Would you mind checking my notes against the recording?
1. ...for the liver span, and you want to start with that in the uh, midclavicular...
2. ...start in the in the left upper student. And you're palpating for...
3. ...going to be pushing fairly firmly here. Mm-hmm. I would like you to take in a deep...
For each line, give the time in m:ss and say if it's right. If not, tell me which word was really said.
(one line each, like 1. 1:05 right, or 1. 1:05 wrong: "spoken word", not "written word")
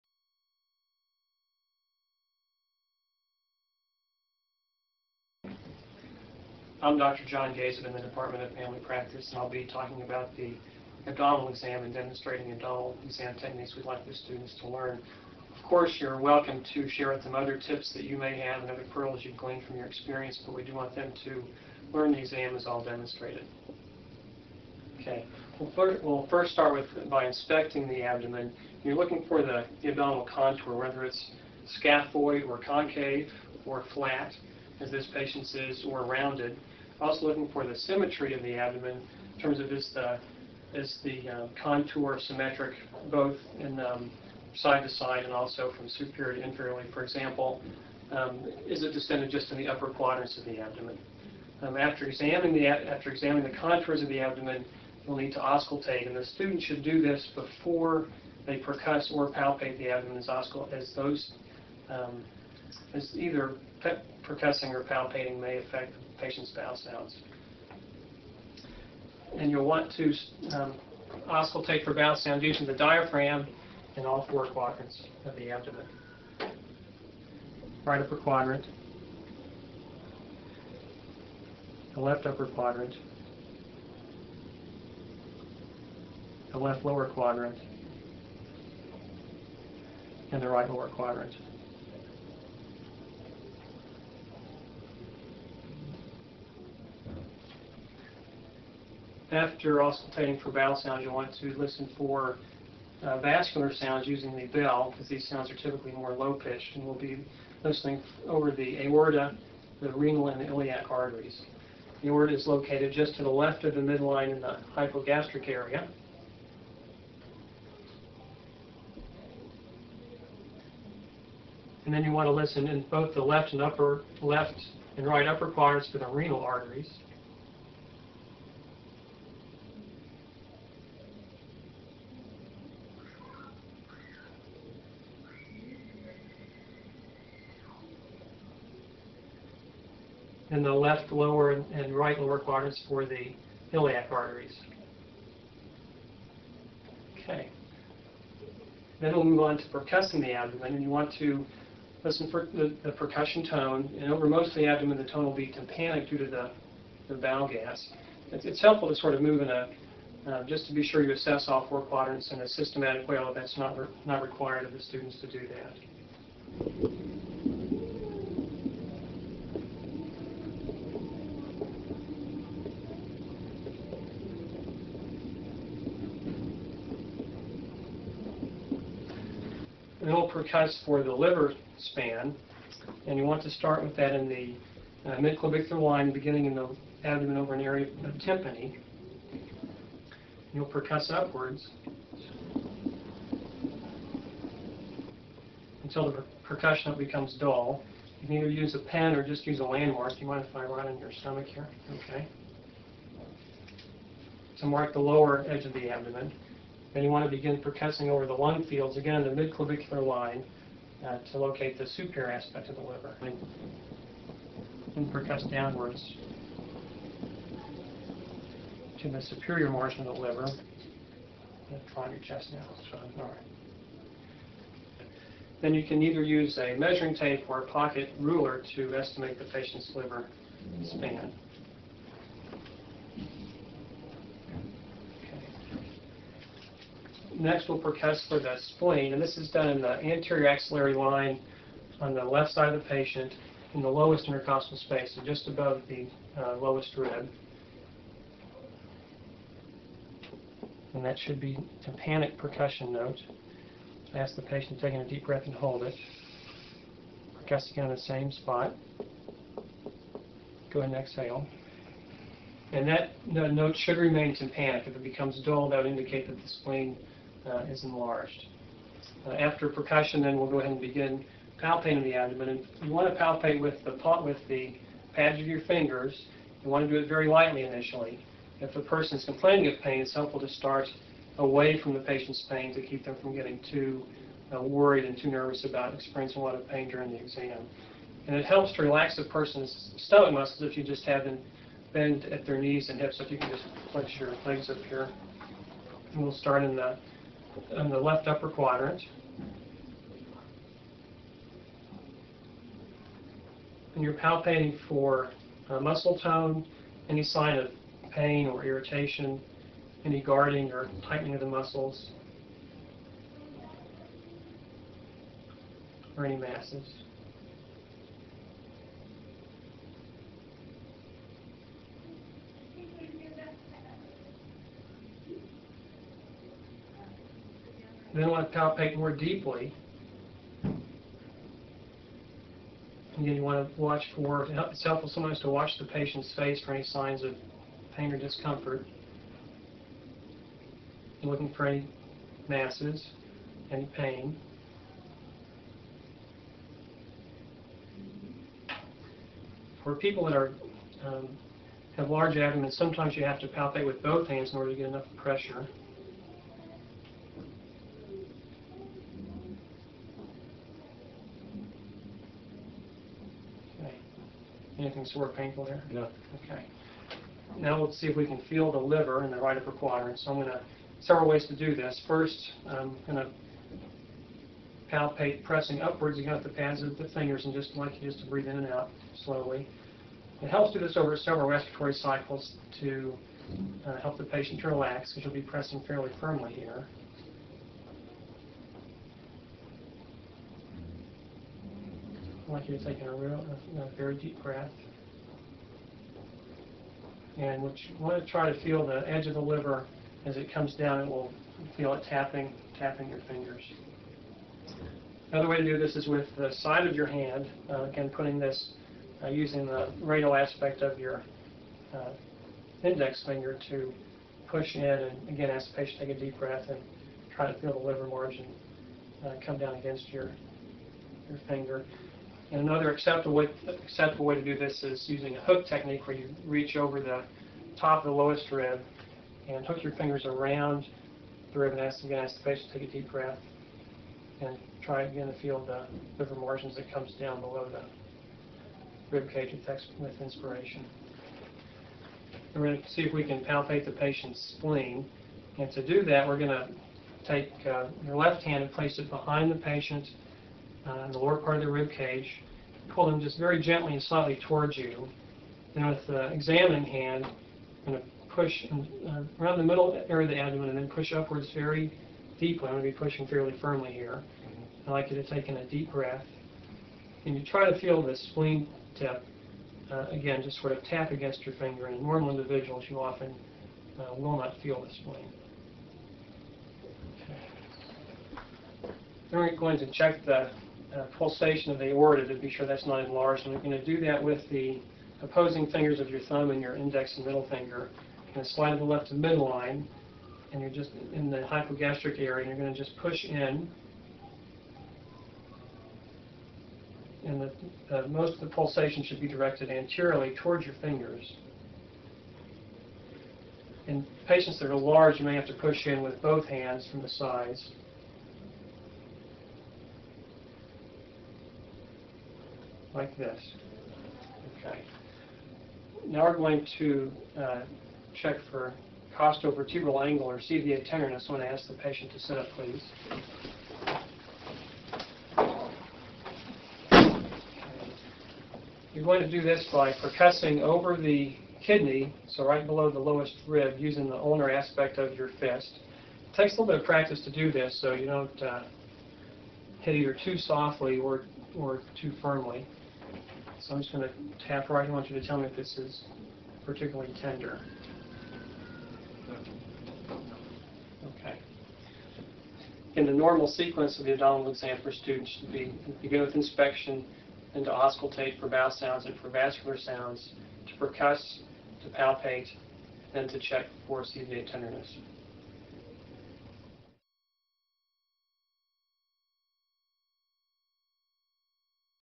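1. 3:00 right
2. 4:56 wrong: "quadrant", not "student"
3. 7:42 right.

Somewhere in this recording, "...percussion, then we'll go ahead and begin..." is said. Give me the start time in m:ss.
4:29.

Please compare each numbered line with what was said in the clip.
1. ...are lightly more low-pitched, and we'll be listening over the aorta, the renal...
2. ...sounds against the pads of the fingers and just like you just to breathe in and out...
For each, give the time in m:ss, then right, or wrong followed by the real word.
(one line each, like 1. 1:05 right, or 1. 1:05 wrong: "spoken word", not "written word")
1. 1:45 wrong: "typically", not "lightly"
2. 6:15 wrong: "upwards", not "sounds".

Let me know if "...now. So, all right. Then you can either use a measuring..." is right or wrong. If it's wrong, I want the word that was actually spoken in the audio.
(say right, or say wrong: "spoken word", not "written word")
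right.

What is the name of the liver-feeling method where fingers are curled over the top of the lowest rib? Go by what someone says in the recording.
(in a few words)
hook technique.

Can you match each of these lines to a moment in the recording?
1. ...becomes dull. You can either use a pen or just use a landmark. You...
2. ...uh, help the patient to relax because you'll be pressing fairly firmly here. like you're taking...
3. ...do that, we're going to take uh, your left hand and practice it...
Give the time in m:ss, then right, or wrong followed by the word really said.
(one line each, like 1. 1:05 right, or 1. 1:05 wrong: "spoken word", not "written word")
1. 3:16 right
2. 6:23 right
3. 7:25 wrong: "place", not "practice".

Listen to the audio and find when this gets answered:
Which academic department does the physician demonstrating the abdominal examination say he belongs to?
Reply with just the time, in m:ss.
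0:08.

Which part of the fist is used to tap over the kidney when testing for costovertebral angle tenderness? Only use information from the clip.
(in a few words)
ulnar aspect.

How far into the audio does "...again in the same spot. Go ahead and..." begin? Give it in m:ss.
4:17.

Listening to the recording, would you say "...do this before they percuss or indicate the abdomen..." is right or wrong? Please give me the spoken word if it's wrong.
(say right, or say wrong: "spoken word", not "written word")
wrong: "palpate", not "indicate".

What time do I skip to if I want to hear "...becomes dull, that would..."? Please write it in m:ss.
4:25.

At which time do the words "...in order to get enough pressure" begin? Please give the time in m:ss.
5:54.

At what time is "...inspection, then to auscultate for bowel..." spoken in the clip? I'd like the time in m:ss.
9:16.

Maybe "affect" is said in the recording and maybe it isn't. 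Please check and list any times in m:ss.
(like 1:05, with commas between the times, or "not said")
1:05.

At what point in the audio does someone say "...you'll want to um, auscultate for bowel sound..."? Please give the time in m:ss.
1:09.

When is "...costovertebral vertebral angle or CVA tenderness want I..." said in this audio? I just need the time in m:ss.
8:39.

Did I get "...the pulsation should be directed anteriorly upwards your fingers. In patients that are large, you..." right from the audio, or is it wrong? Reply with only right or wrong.
wrong.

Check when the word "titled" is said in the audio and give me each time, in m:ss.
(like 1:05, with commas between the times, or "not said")
not said.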